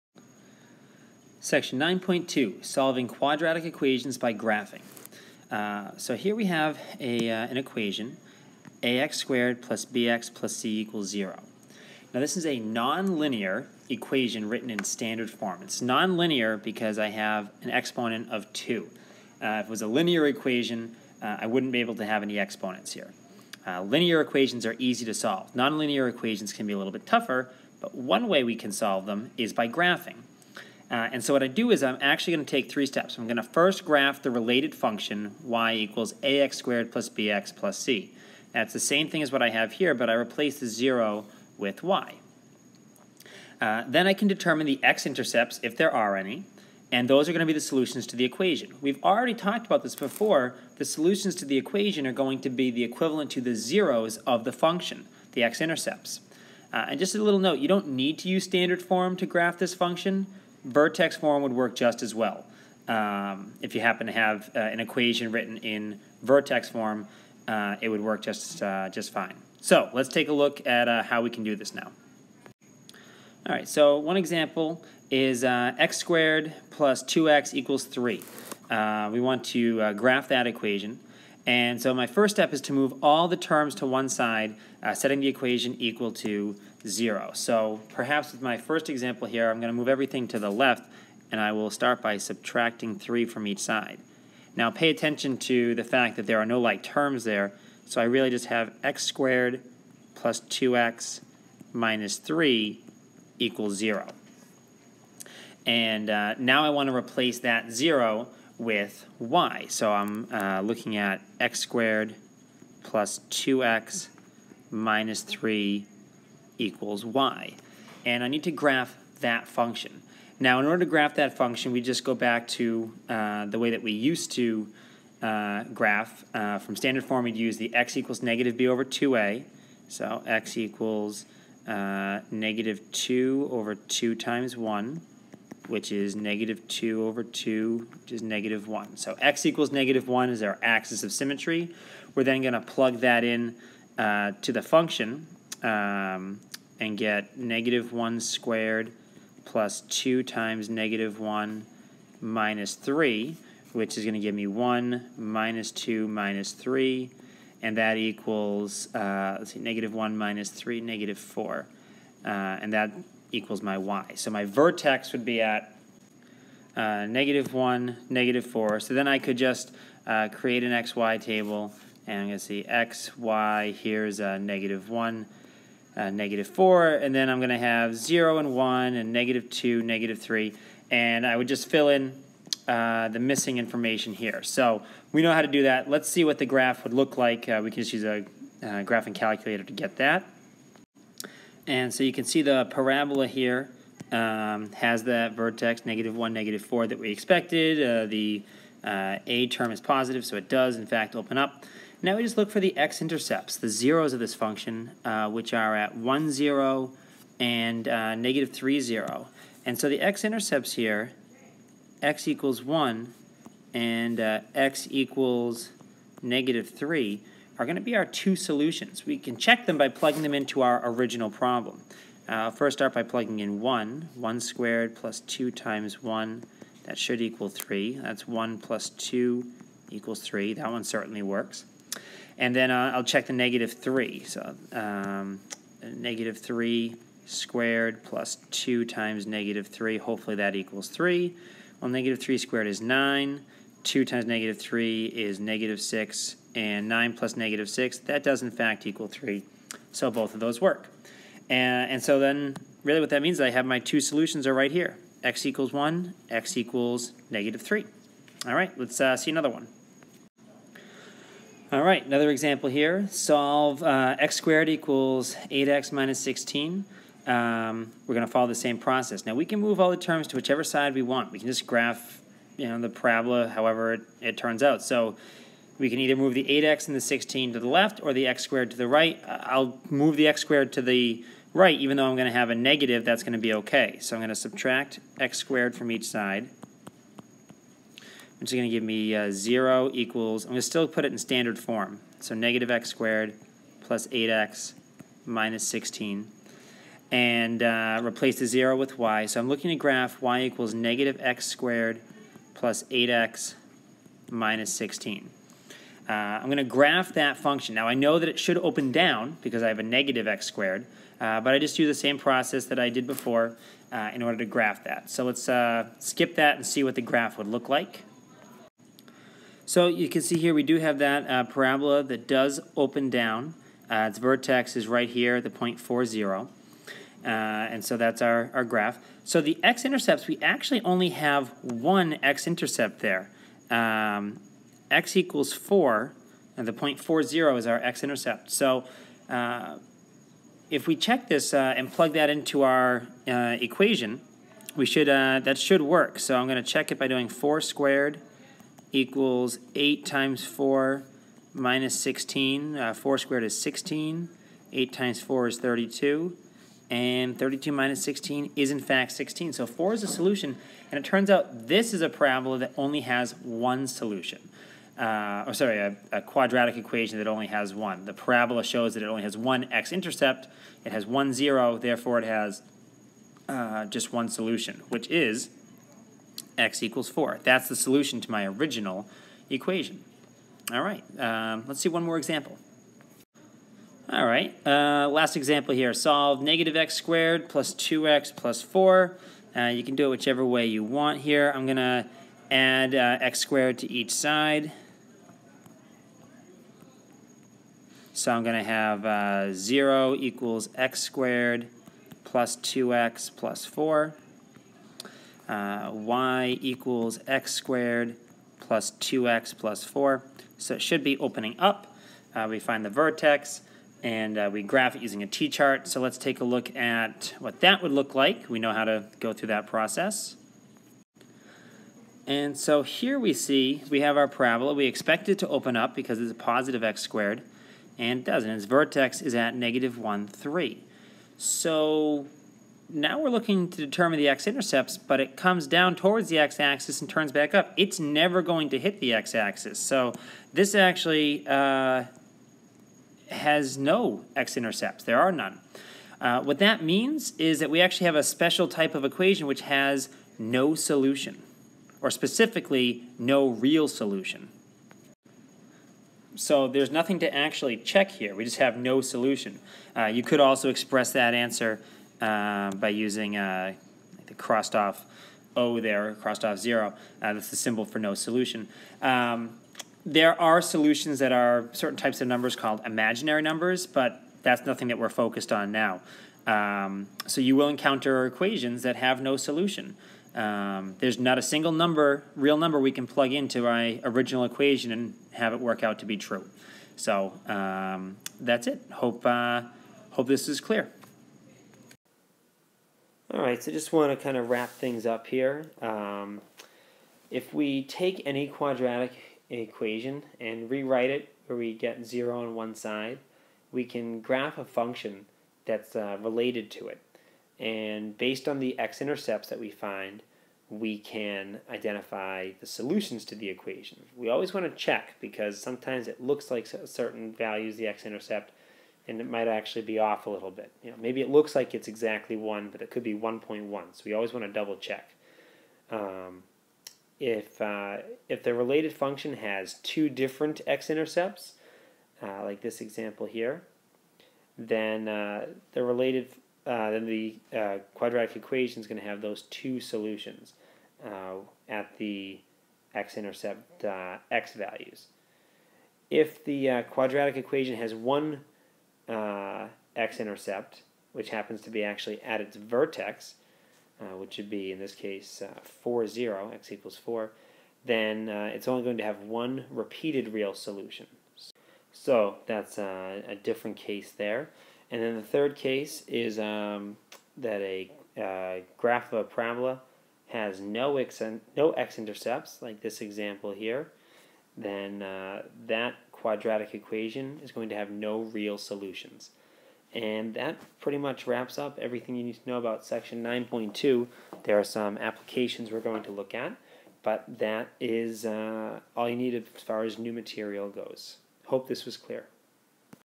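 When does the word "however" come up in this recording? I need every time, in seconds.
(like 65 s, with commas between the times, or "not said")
273 s.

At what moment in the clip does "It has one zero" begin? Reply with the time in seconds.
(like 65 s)
370 s.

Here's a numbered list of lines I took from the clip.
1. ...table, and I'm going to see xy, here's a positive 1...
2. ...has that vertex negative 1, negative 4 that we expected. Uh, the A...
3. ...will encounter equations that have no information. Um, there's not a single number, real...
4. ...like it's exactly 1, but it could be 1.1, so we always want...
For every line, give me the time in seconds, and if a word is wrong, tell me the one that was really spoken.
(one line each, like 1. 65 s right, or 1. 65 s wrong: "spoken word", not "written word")
1. 171 s wrong: "negative", not "positive"
2. 194 s right
3. 477 s wrong: "solution", not "information"
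4. 521 s right.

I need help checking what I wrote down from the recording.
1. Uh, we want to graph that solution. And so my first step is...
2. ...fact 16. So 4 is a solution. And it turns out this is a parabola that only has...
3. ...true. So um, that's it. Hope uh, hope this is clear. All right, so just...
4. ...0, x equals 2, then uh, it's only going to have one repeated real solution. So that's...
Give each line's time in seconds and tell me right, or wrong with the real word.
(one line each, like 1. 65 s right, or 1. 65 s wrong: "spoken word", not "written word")
1. 78 s wrong: "equation", not "solution"
2. 358 s right
3. 486 s right
4. 556 s wrong: "4", not "2".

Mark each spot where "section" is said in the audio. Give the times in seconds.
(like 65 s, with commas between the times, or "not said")
1 s, 582 s.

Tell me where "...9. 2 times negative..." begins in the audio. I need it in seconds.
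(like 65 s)
242 s.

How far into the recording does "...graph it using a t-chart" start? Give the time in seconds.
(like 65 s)
414 s.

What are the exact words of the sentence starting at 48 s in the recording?
We've already talked about this before.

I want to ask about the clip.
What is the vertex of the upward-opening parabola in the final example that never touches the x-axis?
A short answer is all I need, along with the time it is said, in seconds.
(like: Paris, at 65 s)
(-1, 3), at 429 s.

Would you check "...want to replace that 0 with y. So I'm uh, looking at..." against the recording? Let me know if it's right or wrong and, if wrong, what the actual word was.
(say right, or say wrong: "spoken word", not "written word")
right.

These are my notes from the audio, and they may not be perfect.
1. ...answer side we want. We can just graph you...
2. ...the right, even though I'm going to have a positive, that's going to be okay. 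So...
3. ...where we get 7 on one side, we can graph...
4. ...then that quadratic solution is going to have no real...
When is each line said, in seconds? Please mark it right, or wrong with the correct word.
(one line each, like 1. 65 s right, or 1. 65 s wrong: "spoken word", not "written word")
1. 270 s wrong: "whichever", not "answer"
2. 280 s wrong: "negative", not "positive"
3. 501 s wrong: "0", not "7"
4. 574 s wrong: "equation", not "solution".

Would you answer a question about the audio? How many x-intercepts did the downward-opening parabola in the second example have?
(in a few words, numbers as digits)
1.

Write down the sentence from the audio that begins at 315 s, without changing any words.
So let's uh, skip that and see what the graph would look like.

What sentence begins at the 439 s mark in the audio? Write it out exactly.
So this actually uh, has no x-intercepts.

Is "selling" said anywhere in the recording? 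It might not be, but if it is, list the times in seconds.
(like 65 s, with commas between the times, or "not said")
not said.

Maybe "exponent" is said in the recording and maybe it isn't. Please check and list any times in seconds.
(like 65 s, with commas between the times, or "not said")
17 s, 22 s.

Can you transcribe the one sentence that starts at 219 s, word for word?
We can check them by plugging them into our original problem.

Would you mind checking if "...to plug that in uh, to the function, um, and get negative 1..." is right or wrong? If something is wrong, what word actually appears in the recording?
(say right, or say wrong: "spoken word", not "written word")
right.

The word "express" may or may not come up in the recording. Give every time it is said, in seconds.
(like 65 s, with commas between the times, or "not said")
460 s.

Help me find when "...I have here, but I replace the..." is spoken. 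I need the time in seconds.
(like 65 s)
39 s.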